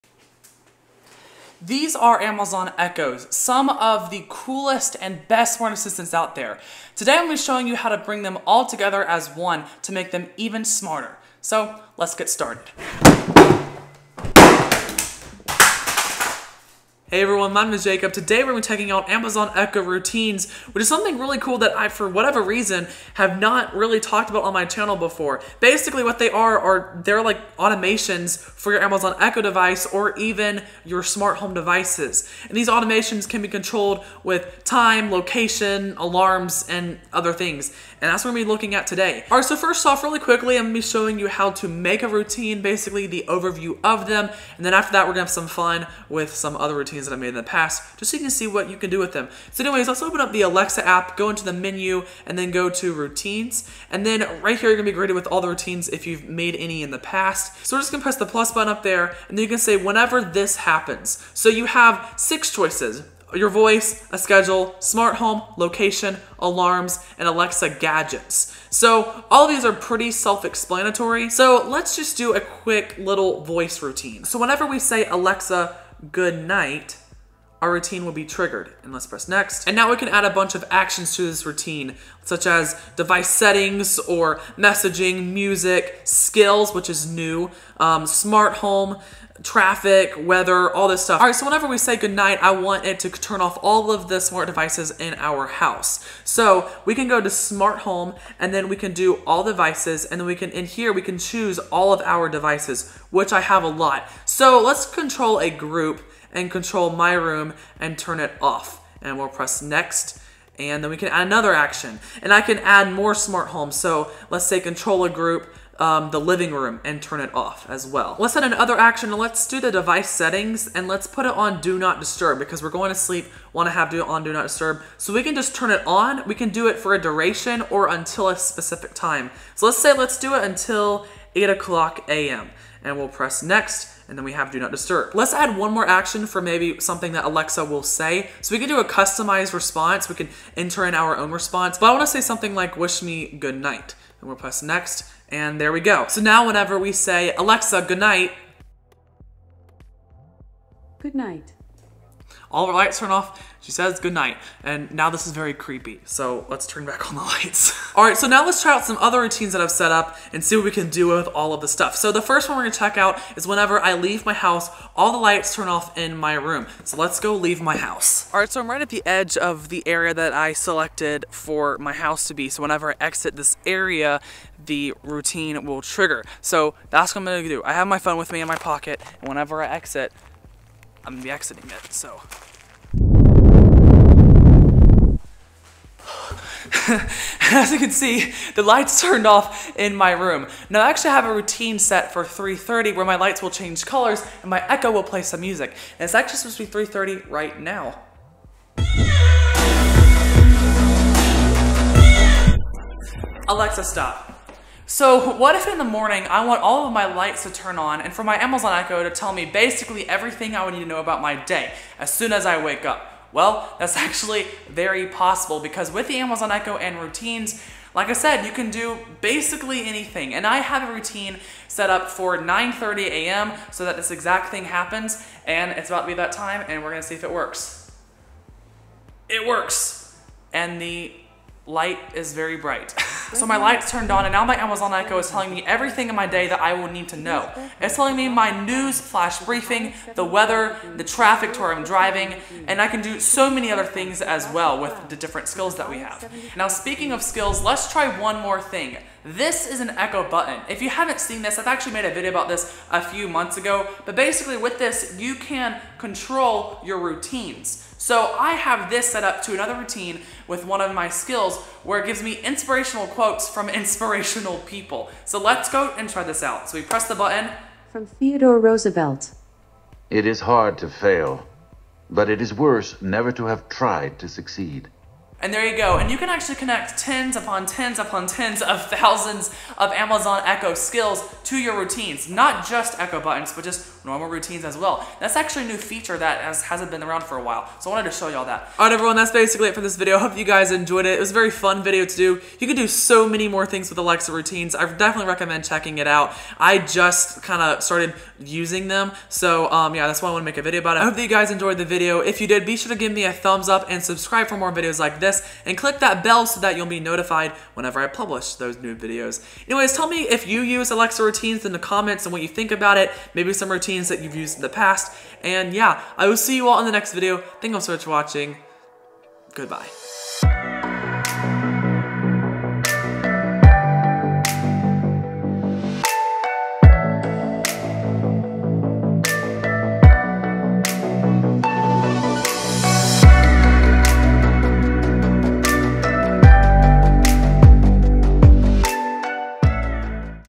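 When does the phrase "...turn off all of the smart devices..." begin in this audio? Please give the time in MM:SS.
01:33.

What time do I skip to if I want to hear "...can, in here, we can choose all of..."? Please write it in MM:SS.
01:40.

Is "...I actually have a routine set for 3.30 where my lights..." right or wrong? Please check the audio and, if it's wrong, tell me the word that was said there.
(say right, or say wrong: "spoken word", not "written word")
right.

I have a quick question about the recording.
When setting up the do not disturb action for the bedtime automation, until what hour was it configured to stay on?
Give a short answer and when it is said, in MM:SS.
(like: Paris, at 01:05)
8 a.m., at 02:11.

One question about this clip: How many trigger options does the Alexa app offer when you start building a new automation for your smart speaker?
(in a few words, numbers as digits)
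6.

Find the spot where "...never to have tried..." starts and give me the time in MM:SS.
04:33.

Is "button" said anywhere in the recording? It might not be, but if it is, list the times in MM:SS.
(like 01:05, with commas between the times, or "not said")
00:58, 04:10, 04:27, 04:43.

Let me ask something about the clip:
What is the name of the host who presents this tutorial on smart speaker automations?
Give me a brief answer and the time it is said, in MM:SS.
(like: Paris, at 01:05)
Jacob, at 00:17.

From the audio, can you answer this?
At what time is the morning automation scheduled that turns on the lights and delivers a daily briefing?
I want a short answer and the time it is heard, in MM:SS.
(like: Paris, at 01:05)
9:30 a.m., at 03:42.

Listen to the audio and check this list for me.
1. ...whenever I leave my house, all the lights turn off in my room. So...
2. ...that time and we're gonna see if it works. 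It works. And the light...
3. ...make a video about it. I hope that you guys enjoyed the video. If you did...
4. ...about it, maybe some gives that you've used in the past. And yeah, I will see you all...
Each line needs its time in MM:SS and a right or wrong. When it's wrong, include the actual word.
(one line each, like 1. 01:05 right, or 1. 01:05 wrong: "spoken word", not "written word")
1. 02:43 right
2. 03:46 right
3. 05:00 right
4. 05:12 wrong: "routines", not "gives".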